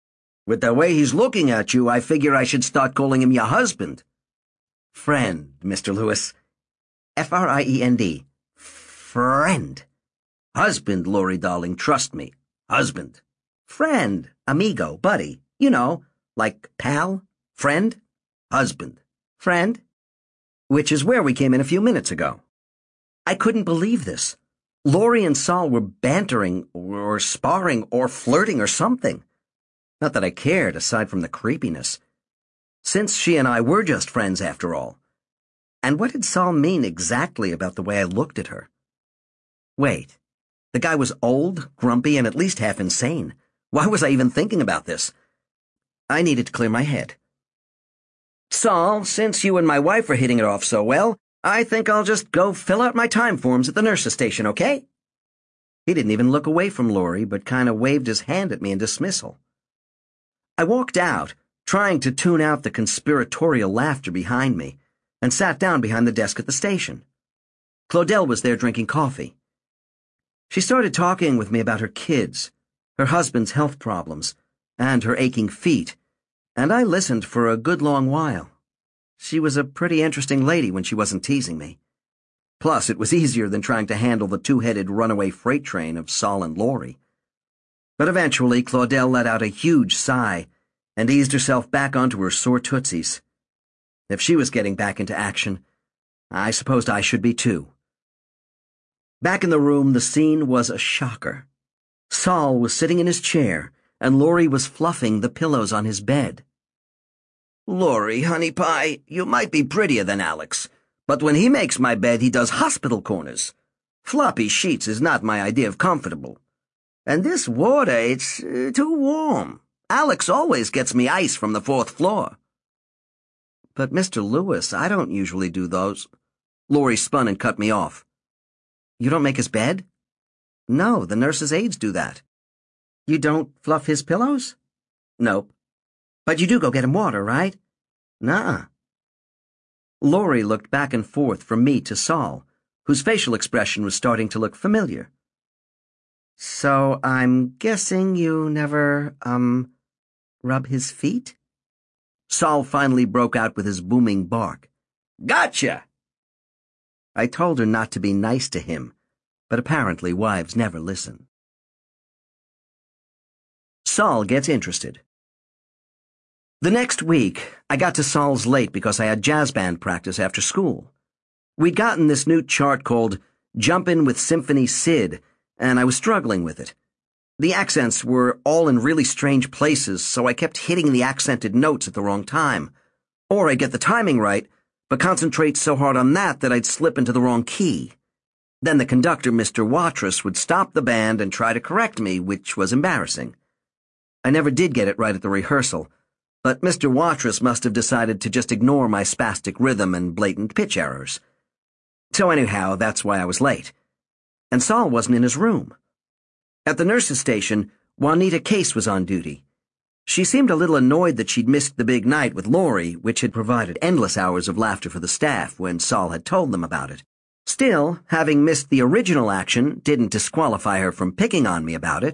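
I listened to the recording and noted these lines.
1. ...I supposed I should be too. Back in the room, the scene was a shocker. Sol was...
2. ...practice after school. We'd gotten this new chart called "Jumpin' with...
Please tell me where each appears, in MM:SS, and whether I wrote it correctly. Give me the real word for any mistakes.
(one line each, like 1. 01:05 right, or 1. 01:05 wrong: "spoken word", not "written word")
1. 01:36 right
2. 02:49 right.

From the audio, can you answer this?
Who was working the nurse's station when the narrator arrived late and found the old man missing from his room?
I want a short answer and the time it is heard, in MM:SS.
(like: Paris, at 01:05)
Juanita Case, at 03:27.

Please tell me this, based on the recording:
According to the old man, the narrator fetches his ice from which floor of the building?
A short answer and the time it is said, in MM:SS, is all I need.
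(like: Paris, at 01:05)
fourth floor, at 02:01.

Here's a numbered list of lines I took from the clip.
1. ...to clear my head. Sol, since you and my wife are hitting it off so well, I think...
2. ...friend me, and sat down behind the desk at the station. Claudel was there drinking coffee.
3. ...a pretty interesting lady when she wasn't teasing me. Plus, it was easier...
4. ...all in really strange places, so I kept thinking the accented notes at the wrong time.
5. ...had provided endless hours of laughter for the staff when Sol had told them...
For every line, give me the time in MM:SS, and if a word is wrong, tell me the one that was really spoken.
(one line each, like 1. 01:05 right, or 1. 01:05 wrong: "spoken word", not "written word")
1. 00:46 right
2. 01:04 wrong: "behind", not "friend"
3. 01:19 right
4. 02:58 wrong: "hitting", not "thinking"
5. 03:33 right.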